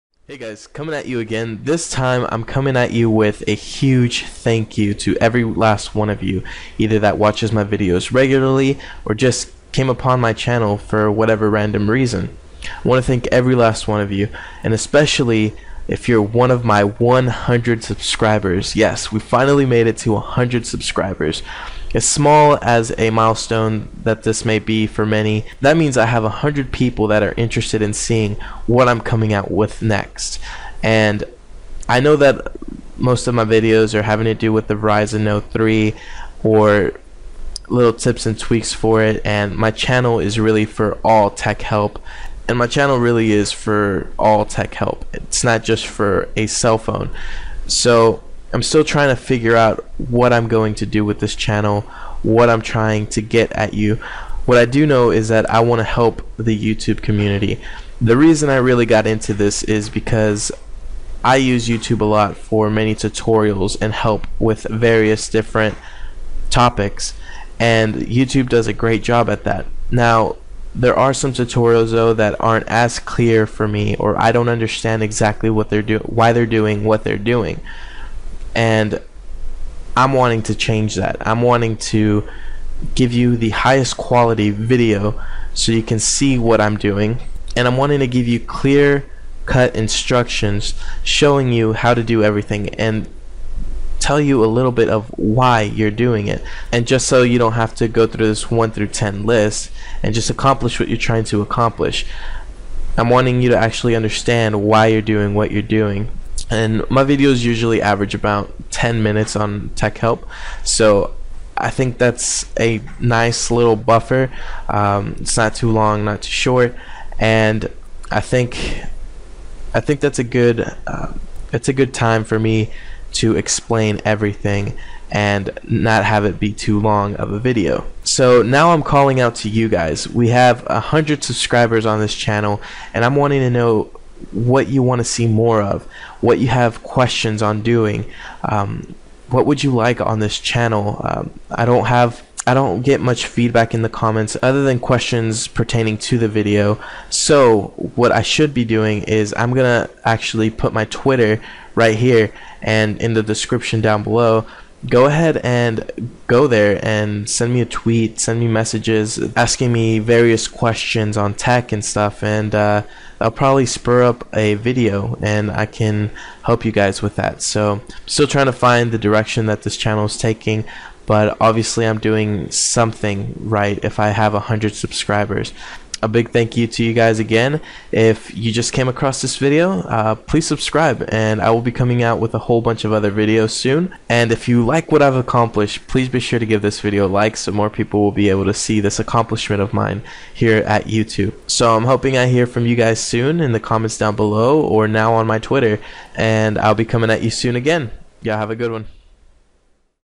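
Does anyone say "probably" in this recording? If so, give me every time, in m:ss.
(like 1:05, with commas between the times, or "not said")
2:43.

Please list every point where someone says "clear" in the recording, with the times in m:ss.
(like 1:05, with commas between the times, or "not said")
1:12, 1:28.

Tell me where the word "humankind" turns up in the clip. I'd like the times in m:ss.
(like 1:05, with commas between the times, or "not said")
not said.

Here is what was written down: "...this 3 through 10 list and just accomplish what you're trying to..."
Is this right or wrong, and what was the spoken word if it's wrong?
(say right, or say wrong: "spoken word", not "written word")
wrong: "1", not "3".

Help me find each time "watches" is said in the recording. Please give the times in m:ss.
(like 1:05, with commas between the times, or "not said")
0:07.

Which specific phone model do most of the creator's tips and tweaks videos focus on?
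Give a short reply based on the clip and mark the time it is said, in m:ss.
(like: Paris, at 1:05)
Verizon Note 3, at 0:34.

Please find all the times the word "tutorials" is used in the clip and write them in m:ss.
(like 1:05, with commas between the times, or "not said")
1:02, 1:11.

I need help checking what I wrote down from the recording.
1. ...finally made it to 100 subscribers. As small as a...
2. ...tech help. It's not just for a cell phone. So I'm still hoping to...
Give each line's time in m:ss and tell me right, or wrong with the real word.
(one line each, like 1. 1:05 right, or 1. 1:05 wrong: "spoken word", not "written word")
1. 0:19 right
2. 0:44 wrong: "trying", not "hoping".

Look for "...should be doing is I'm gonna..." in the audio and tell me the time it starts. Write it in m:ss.
2:28.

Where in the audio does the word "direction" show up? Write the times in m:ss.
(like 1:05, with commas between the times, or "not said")
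2:48.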